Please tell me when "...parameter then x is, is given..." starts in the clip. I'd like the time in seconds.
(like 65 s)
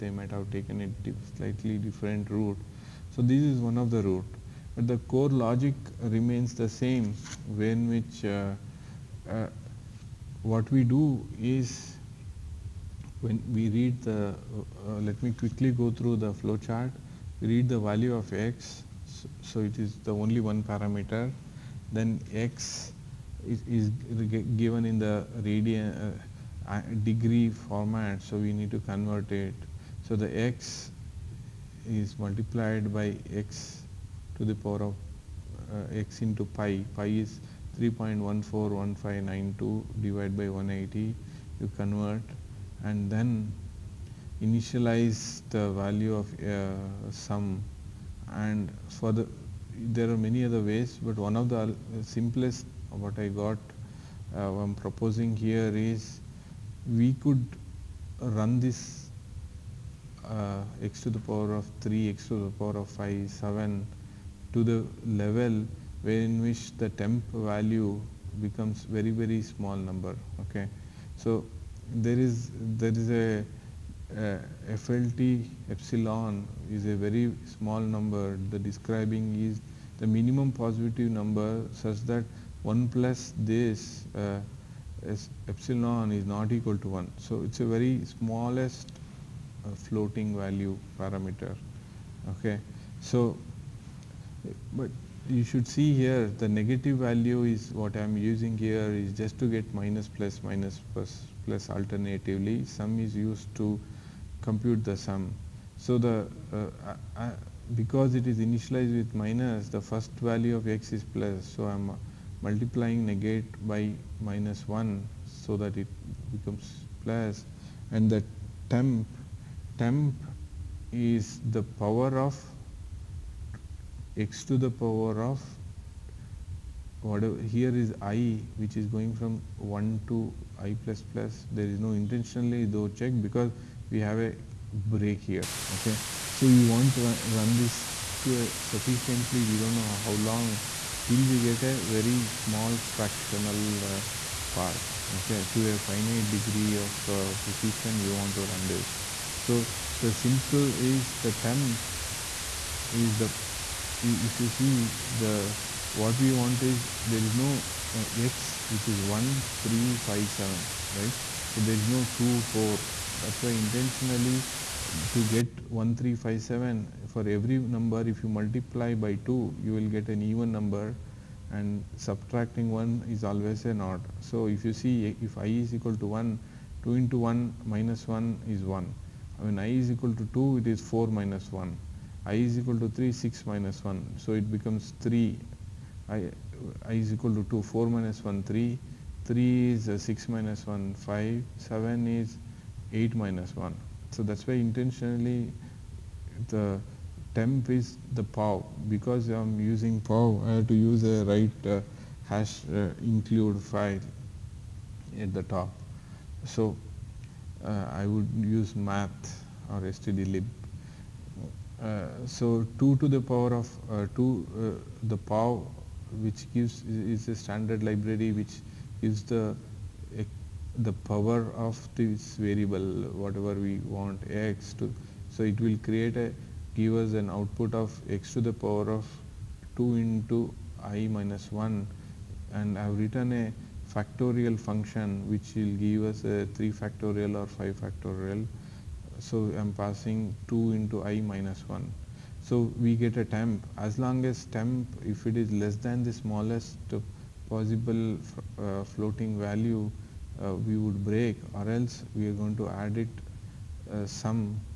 20 s.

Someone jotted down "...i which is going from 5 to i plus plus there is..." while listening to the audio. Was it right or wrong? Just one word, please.
wrong.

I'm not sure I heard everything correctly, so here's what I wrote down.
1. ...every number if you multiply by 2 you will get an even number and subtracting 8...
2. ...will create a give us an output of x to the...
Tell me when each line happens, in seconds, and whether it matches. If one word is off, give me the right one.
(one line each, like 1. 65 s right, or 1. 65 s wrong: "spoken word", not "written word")
1. 167 s wrong: "1", not "8"
2. 225 s right.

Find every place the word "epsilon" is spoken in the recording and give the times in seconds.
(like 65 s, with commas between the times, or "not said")
75 s, 85 s.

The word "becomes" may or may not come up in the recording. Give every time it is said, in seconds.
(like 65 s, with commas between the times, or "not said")
68 s, 116 s, 184 s.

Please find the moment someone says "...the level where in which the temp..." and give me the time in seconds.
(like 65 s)
64 s.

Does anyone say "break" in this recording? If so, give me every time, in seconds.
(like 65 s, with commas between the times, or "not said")
134 s, 251 s.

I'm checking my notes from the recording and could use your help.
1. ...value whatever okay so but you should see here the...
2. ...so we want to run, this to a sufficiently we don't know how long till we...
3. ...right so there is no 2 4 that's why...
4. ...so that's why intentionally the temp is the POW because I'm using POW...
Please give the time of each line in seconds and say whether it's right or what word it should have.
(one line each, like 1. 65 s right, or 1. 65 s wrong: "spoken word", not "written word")
1. 90 s wrong: "parameter", not "whatever"
2. 136 s right
3. 160 s right
4. 194 s right.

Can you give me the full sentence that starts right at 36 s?
Pi is 3.141592 divided by 180.